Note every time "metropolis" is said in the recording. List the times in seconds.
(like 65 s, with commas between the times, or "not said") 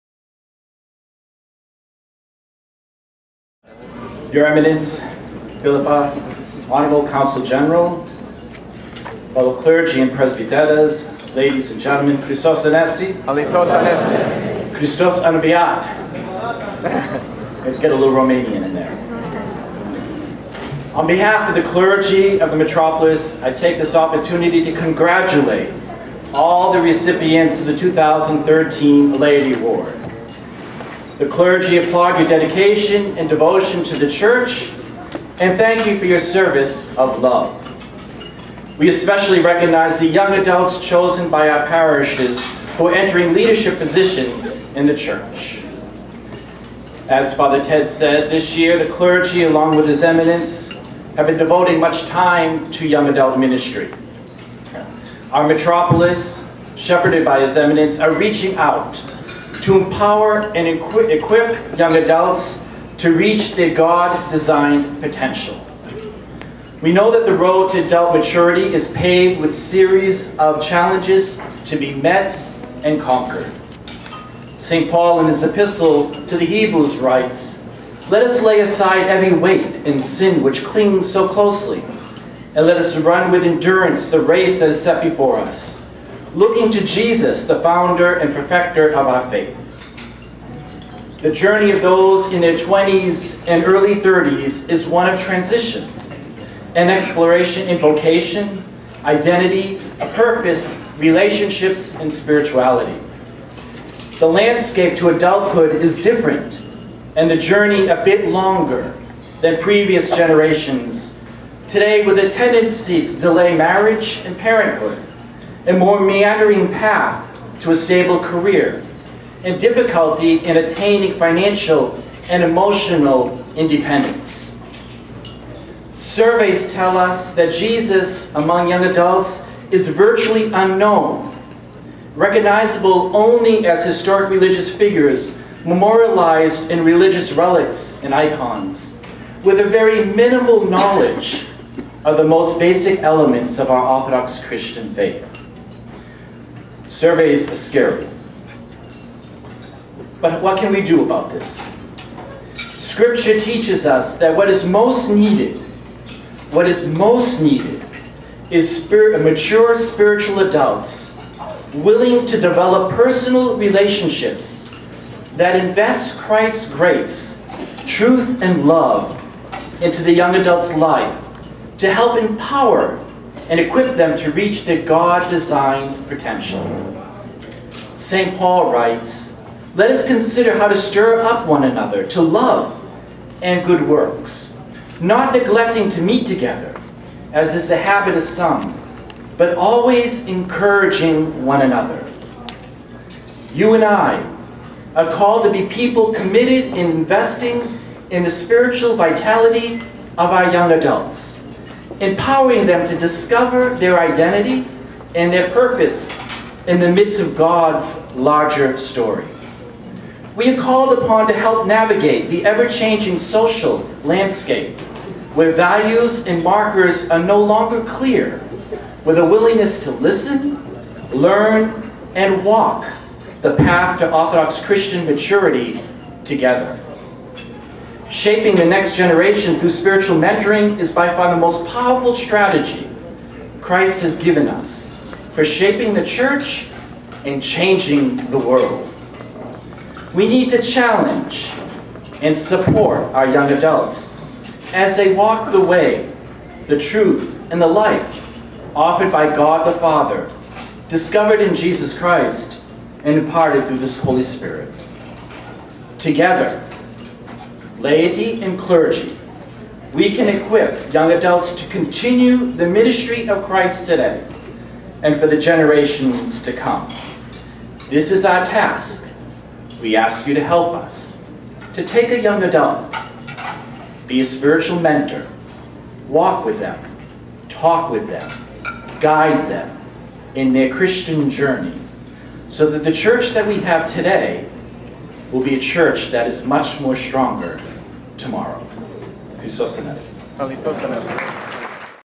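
22 s, 55 s.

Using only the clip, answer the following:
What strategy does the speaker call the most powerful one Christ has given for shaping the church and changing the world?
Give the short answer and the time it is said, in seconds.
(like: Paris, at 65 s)
Spiritual mentoring, at 229 s.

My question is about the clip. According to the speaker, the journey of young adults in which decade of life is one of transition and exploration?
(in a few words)
Their 20s.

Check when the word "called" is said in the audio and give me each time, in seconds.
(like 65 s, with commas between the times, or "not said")
195 s, 210 s.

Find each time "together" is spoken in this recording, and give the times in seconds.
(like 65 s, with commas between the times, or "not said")
186 s, 226 s, 255 s.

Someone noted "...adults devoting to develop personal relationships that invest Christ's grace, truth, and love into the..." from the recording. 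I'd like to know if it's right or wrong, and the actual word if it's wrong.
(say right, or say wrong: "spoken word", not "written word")
wrong: "willing", not "devoting".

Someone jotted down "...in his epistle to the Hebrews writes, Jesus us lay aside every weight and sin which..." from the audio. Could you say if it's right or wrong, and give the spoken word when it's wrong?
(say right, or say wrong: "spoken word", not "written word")
wrong: "Let", not "Jesus".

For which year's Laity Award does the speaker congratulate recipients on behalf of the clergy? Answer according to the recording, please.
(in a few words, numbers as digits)
2013.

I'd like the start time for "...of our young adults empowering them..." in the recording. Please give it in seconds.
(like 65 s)
200 s.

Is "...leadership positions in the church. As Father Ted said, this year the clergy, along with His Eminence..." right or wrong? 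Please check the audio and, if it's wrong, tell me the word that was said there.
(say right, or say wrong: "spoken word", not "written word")
right.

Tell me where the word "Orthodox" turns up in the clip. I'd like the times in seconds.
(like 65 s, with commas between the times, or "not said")
143 s, 224 s.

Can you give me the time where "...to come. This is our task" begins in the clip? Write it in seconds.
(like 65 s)
266 s.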